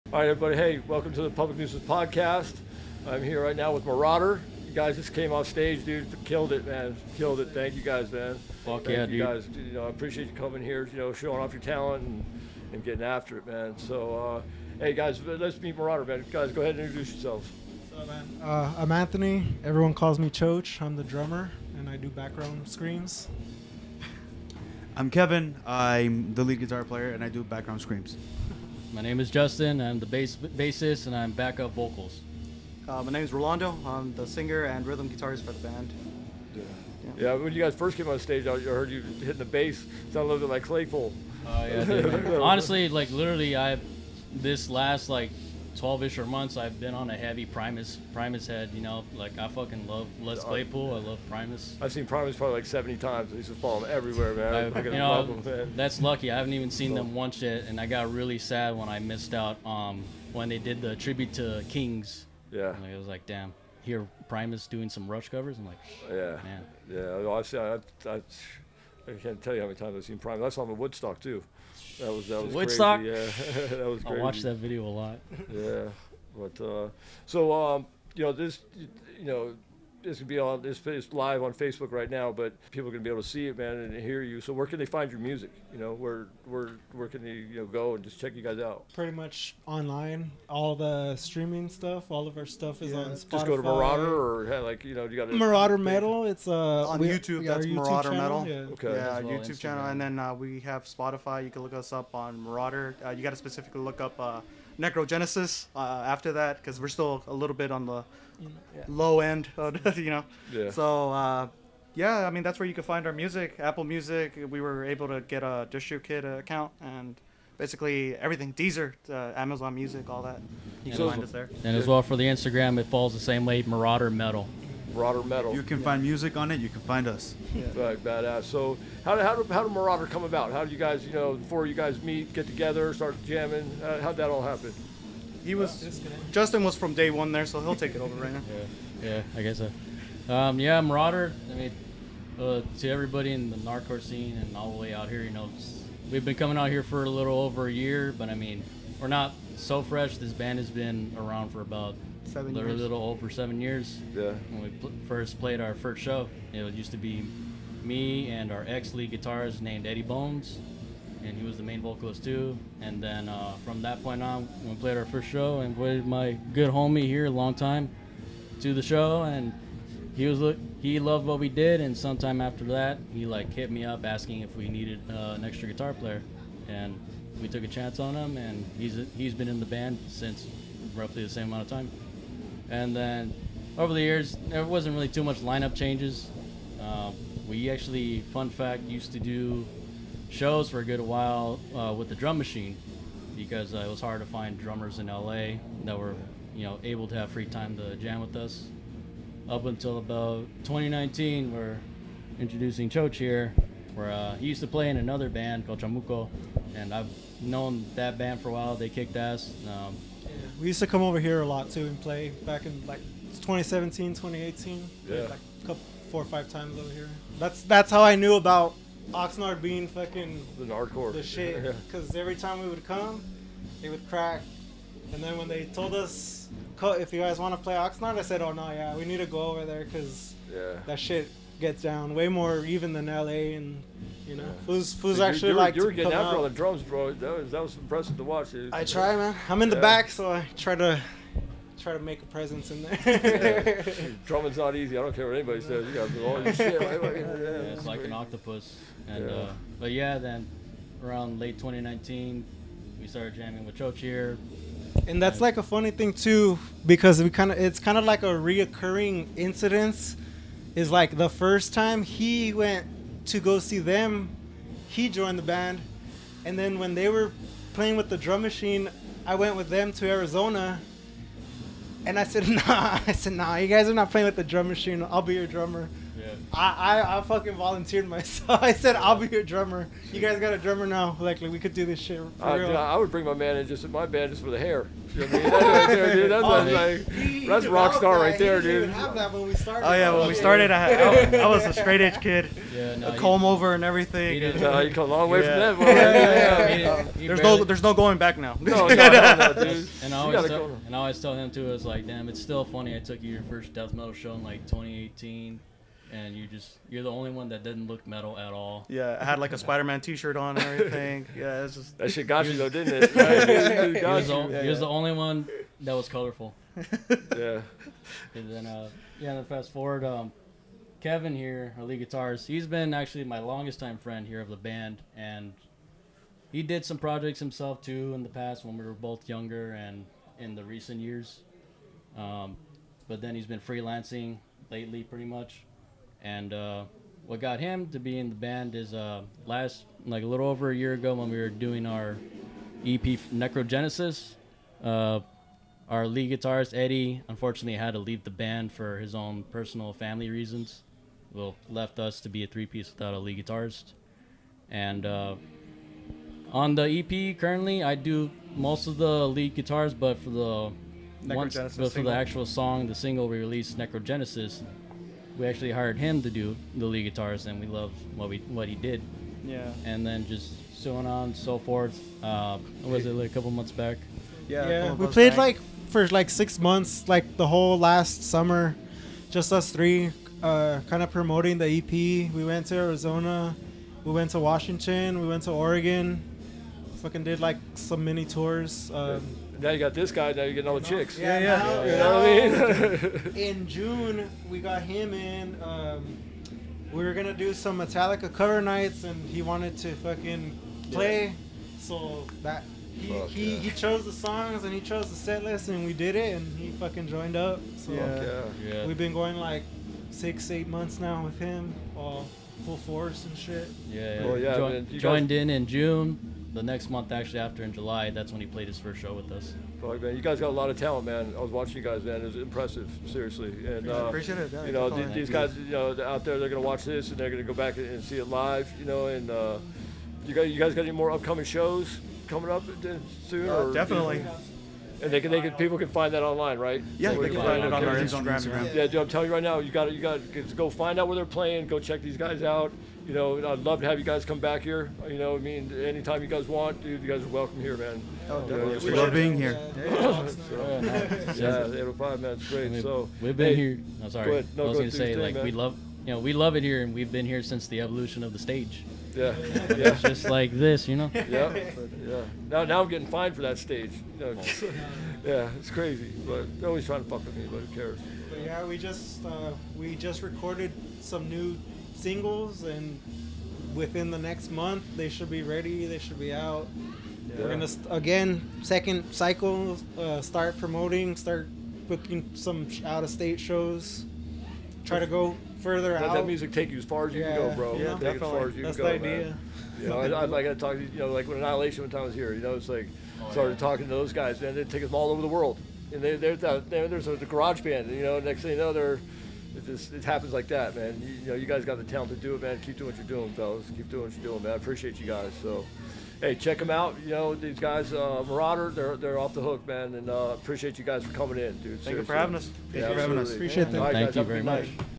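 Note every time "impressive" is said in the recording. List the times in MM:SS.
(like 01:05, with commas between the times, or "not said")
03:57, 07:02.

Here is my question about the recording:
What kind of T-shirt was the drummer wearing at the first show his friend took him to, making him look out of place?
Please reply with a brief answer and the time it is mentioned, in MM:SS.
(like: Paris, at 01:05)
Spider-Man T-shirt, at 05:09.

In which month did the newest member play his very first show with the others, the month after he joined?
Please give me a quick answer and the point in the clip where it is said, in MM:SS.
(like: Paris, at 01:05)
July, at 06:57.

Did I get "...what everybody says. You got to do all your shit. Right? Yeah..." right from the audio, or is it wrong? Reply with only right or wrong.
wrong.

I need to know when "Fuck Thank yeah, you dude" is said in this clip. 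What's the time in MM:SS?
00:08.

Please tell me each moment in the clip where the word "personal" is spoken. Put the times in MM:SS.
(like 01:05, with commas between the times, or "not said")
05:49.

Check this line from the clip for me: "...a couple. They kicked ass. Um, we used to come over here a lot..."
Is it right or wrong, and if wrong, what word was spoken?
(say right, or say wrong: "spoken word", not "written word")
wrong: "while", not "couple".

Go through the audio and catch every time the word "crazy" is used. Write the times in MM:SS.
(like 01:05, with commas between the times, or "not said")
01:13, 04:07, 07:45.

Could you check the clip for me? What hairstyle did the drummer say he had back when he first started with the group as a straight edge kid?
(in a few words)
A comb over.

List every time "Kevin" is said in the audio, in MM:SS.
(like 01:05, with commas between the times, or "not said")
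00:25, 05:20.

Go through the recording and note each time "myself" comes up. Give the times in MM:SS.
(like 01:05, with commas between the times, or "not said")
04:38.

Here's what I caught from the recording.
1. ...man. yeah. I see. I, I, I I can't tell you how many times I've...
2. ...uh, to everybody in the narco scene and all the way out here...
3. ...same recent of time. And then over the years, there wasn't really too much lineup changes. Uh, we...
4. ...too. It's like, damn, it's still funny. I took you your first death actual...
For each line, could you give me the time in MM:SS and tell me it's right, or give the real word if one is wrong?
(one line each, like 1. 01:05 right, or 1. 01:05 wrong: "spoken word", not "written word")
1. 01:06 right
2. 02:22 right
3. 03:01 wrong: "amount", not "recent"
4. 05:01 wrong: "metal", not "actual".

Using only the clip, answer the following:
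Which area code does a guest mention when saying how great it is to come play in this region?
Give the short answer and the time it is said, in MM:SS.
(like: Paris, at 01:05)
805, at 07:31.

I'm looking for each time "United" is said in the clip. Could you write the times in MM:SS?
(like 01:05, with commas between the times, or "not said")
not said.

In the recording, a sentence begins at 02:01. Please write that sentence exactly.
And as well for the Instagram, it falls the same way, Marauder Metal.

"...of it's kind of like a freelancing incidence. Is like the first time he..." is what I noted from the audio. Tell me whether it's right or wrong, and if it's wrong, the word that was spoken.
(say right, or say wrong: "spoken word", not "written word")
wrong: "reoccurring", not "freelancing".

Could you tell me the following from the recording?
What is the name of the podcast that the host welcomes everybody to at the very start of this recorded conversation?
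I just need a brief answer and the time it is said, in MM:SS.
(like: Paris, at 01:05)
Public Nuisance Podcast, at 00:01.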